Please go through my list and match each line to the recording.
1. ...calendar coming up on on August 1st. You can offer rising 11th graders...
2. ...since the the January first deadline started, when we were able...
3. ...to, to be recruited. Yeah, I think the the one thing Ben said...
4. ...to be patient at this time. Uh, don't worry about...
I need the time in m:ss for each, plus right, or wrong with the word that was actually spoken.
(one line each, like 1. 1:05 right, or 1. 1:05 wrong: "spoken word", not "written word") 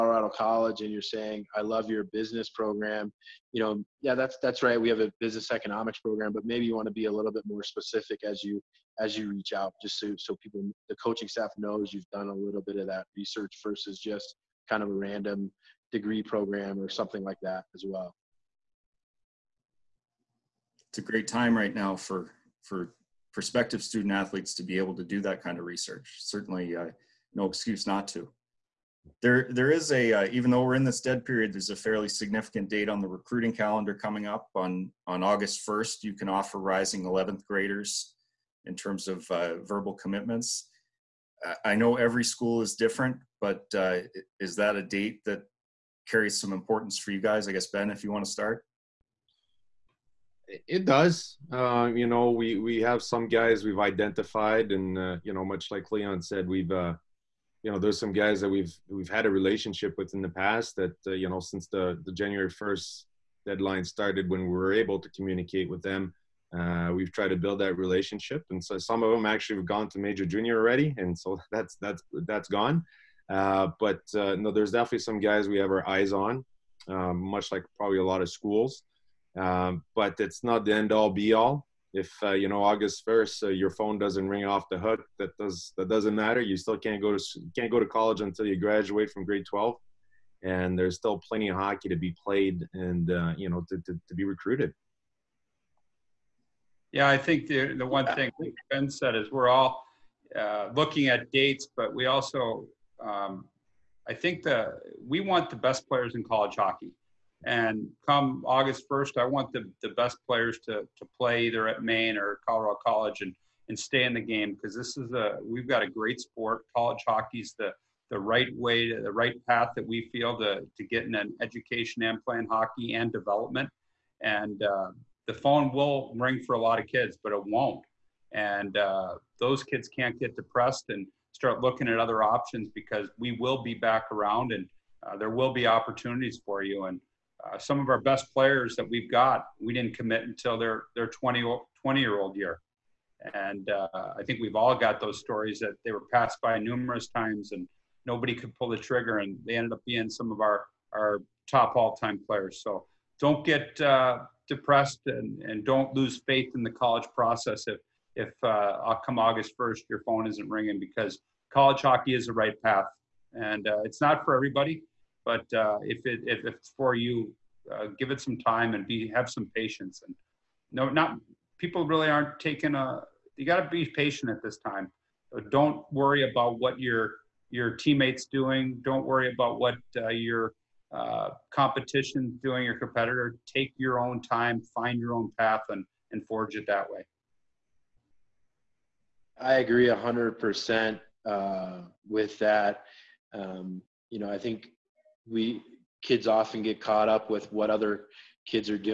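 1. 0:33 right
2. 1:01 right
3. 1:33 right
4. 2:53 right.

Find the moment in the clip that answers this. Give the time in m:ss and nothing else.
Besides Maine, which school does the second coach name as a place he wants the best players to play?
1:52.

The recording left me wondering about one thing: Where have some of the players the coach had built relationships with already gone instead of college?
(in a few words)
Major junior.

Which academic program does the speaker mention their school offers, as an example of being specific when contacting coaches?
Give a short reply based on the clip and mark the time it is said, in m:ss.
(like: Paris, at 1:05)
Business economics, at 0:05.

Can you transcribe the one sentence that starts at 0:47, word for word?
I guess Ben, if you want to start.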